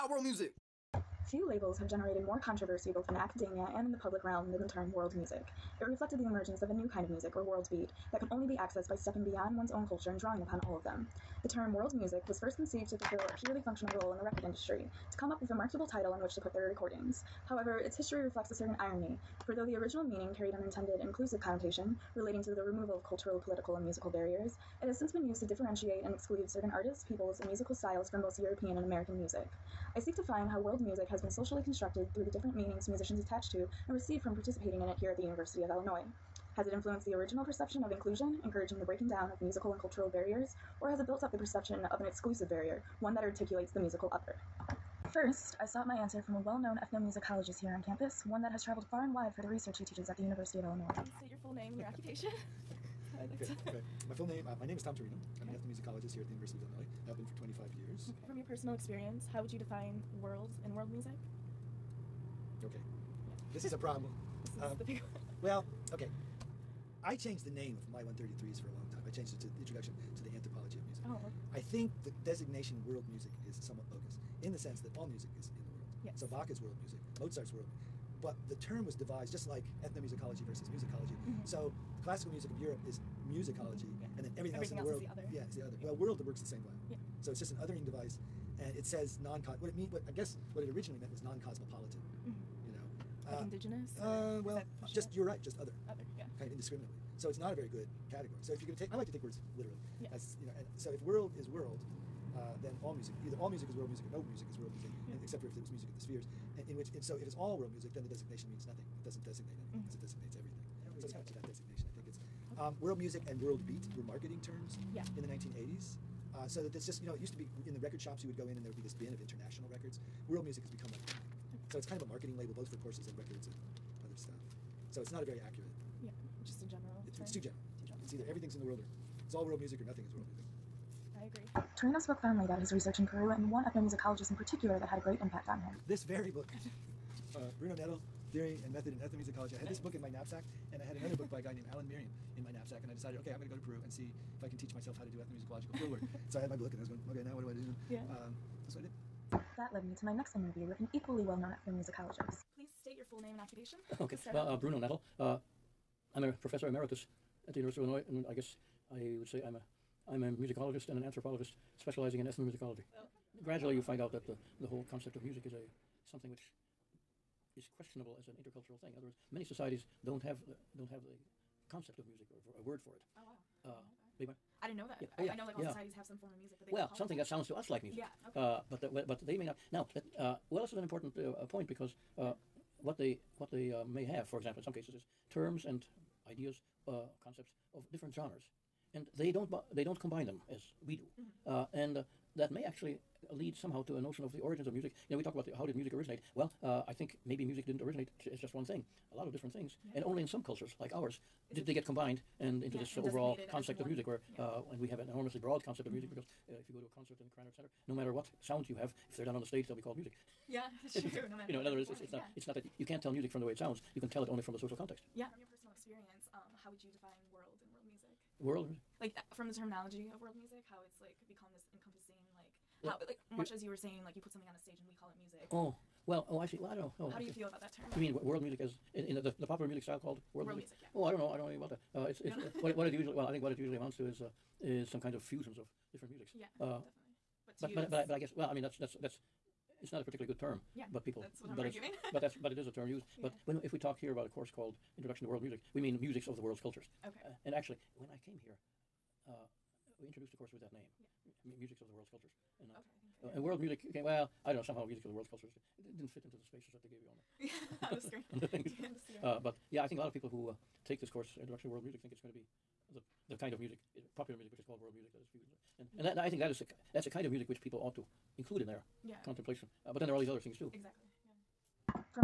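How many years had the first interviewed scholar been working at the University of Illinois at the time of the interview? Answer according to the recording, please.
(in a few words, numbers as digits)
25.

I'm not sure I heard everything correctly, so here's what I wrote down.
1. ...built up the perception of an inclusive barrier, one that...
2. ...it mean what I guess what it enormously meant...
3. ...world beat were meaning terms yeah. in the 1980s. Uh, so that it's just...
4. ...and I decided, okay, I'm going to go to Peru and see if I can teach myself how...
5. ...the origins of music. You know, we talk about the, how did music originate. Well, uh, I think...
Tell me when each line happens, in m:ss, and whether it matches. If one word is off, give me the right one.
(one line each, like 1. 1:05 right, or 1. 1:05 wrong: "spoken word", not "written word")
1. 0:41 wrong: "exclusive", not "inclusive"
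2. 1:29 wrong: "originally", not "enormously"
3. 1:53 wrong: "marketing", not "meaning"
4. 2:22 right
5. 3:14 right.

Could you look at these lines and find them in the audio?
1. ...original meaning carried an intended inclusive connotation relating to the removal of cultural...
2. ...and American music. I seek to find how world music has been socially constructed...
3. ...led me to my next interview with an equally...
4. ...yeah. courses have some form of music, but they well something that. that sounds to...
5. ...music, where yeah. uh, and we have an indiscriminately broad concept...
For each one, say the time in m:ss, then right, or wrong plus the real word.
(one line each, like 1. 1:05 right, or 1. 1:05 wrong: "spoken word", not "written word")
1. 0:19 right
2. 0:28 right
3. 2:29 right
4. 2:55 wrong: "societies", not "courses"
5. 3:23 wrong: "enormously", not "indiscriminately".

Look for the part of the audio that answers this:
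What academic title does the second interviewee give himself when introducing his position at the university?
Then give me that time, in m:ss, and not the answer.
2:36.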